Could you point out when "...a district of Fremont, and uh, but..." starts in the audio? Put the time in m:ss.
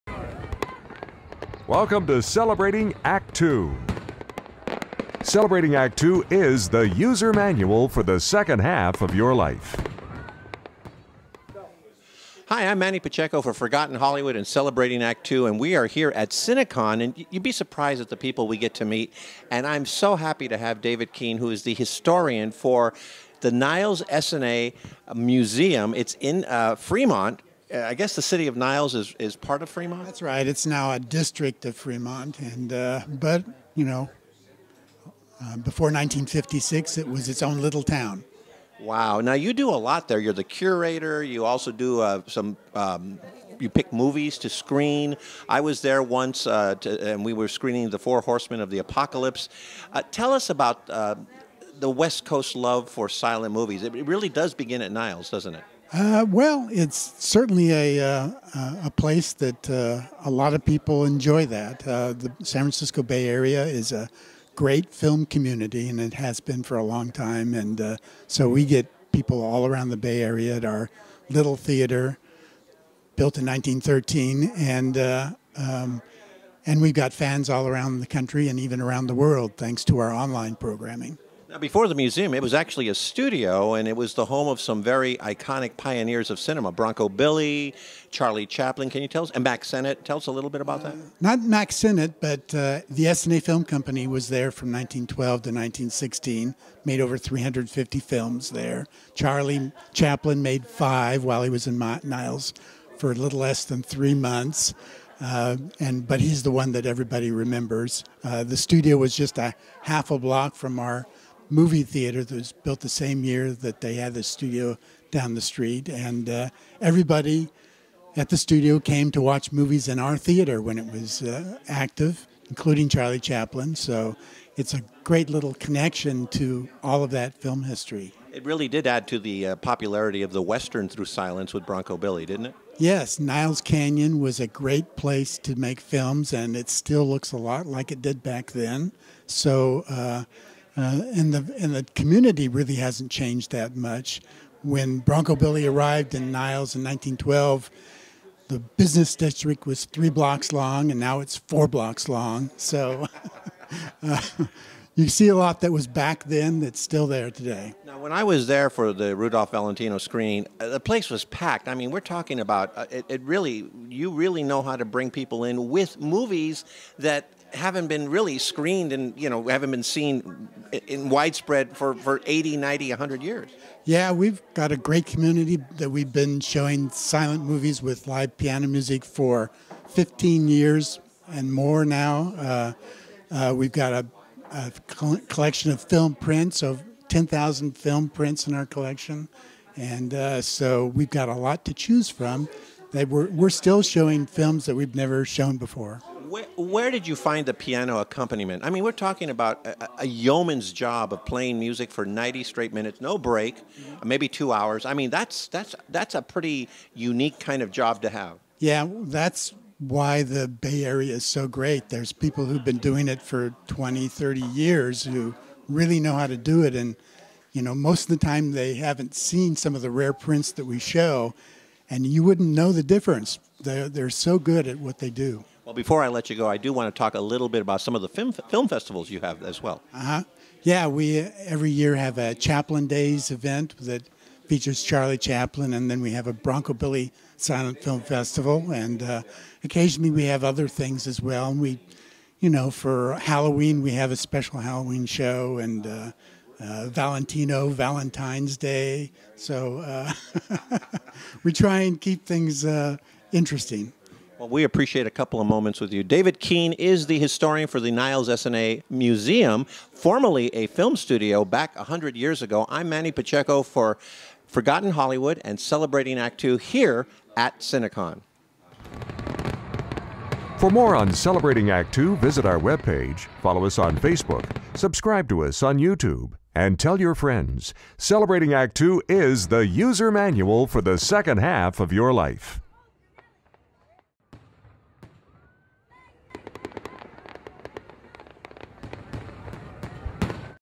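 0:30.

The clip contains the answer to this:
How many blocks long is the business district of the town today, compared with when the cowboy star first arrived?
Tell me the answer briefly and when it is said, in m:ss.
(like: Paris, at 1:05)
4, at 2:31.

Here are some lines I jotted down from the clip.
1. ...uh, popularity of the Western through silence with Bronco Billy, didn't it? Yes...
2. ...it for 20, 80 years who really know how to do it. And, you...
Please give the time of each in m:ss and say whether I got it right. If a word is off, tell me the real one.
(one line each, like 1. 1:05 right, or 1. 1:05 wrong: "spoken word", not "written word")
1. 2:09 right
2. 3:33 wrong: "30", not "80".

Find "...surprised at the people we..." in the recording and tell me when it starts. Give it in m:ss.
0:17.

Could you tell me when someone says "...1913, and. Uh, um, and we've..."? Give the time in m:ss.
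1:13.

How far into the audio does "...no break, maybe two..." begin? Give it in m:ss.
3:23.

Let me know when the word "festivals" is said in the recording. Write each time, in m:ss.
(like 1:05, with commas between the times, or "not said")
3:48, 3:58.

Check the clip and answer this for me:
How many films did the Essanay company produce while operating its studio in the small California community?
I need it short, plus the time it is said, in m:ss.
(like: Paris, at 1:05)
over 350, at 1:37.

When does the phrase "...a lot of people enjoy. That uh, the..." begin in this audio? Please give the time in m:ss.
1:00.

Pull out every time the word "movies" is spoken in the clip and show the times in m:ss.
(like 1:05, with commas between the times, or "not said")
0:43, 0:53, 1:51, 1:59, 2:45, 2:57.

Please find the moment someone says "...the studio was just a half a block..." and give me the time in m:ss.
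1:48.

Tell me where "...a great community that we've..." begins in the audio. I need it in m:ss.
2:54.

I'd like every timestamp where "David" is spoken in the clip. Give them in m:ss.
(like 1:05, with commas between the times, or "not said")
0:20, 4:16.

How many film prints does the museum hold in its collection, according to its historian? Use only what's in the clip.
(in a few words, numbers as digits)
10,000.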